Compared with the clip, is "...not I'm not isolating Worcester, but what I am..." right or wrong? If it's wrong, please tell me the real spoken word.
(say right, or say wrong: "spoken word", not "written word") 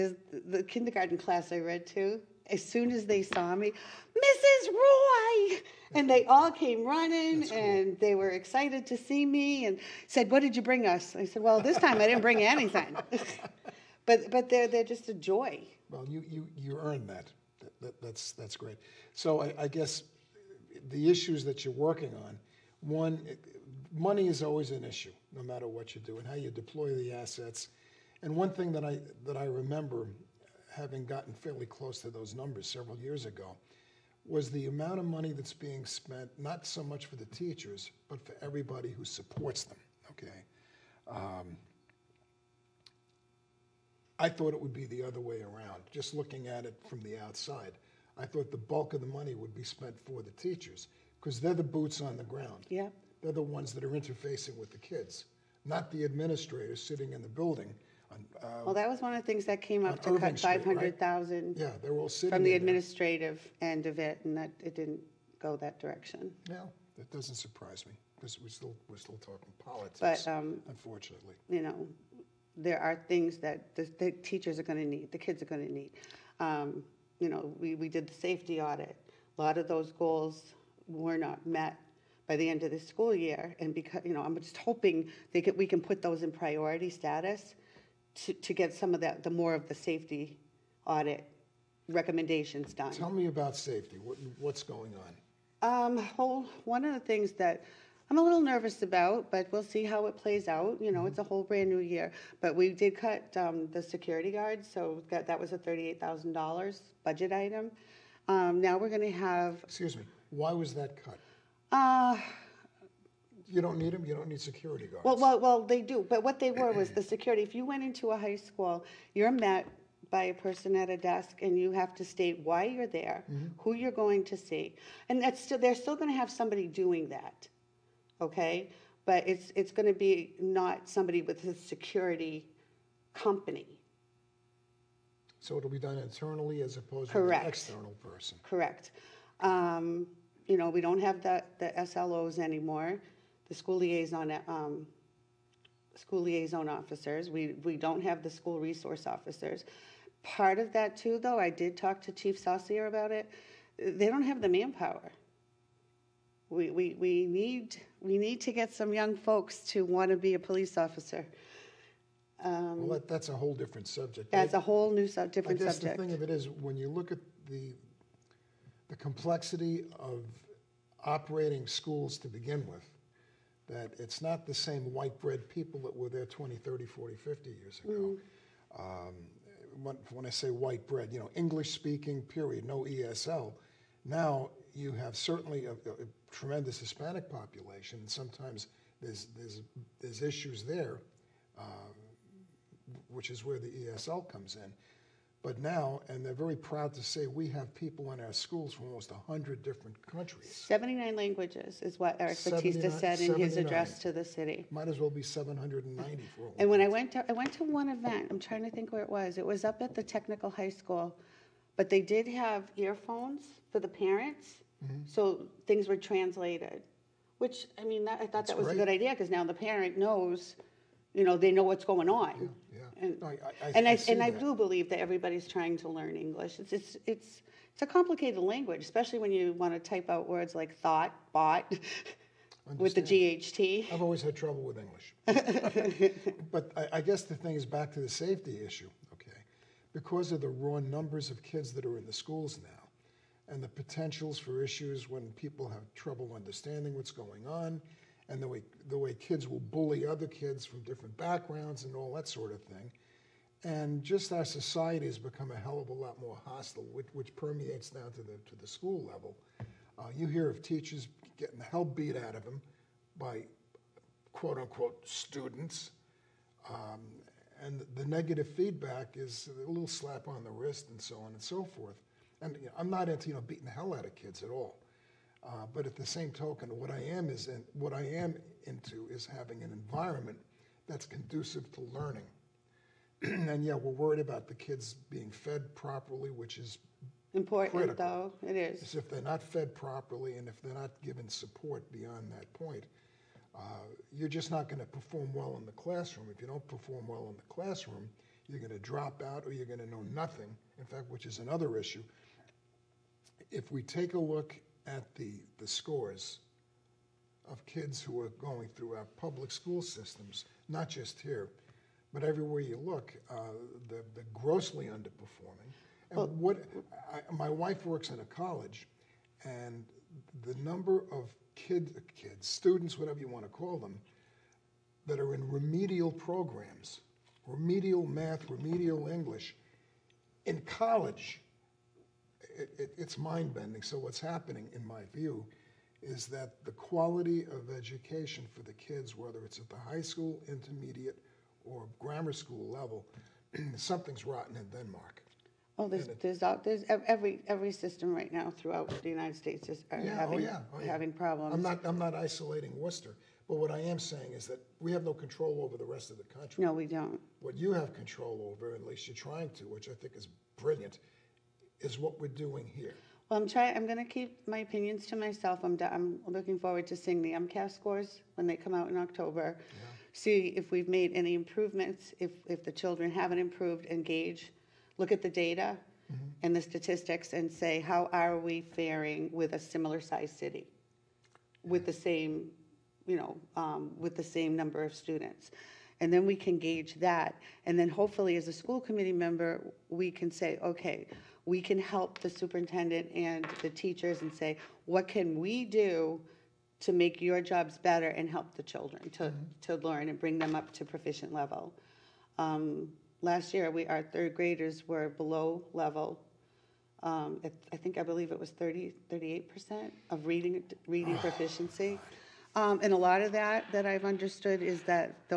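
right.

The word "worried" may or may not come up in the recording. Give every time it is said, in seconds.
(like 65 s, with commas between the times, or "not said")
283 s.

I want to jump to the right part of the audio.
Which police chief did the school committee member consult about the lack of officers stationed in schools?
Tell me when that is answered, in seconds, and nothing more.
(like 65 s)
152 s.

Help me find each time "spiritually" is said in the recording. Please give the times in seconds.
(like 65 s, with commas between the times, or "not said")
not said.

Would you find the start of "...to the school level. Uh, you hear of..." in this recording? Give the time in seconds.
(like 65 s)
258 s.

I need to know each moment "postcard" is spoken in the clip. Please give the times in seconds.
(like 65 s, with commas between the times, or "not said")
not said.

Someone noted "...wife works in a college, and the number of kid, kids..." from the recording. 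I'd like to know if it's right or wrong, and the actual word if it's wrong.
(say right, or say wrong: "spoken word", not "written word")
right.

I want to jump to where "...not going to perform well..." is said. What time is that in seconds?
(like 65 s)
294 s.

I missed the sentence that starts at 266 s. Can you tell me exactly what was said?
Um, and the negative feedback is a little slap on the wrist and so on and so forth.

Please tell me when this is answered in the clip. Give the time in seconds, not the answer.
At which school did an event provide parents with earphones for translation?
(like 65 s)
210 s.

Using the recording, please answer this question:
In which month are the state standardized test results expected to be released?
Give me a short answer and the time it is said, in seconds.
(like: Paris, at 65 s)
October, at 368 s.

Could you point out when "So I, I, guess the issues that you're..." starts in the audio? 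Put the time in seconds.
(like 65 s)
19 s.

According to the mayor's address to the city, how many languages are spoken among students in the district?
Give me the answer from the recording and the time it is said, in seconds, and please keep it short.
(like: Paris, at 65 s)
79, at 200 s.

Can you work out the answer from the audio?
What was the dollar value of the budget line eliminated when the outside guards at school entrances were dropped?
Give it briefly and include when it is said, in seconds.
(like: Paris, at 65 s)
$38,000, at 105 s.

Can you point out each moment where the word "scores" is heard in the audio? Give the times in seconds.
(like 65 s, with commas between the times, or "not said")
305 s, 367 s.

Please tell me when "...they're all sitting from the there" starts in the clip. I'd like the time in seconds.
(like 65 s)
61 s.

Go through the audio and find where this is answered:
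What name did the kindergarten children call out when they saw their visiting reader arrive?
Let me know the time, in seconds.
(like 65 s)
4 s.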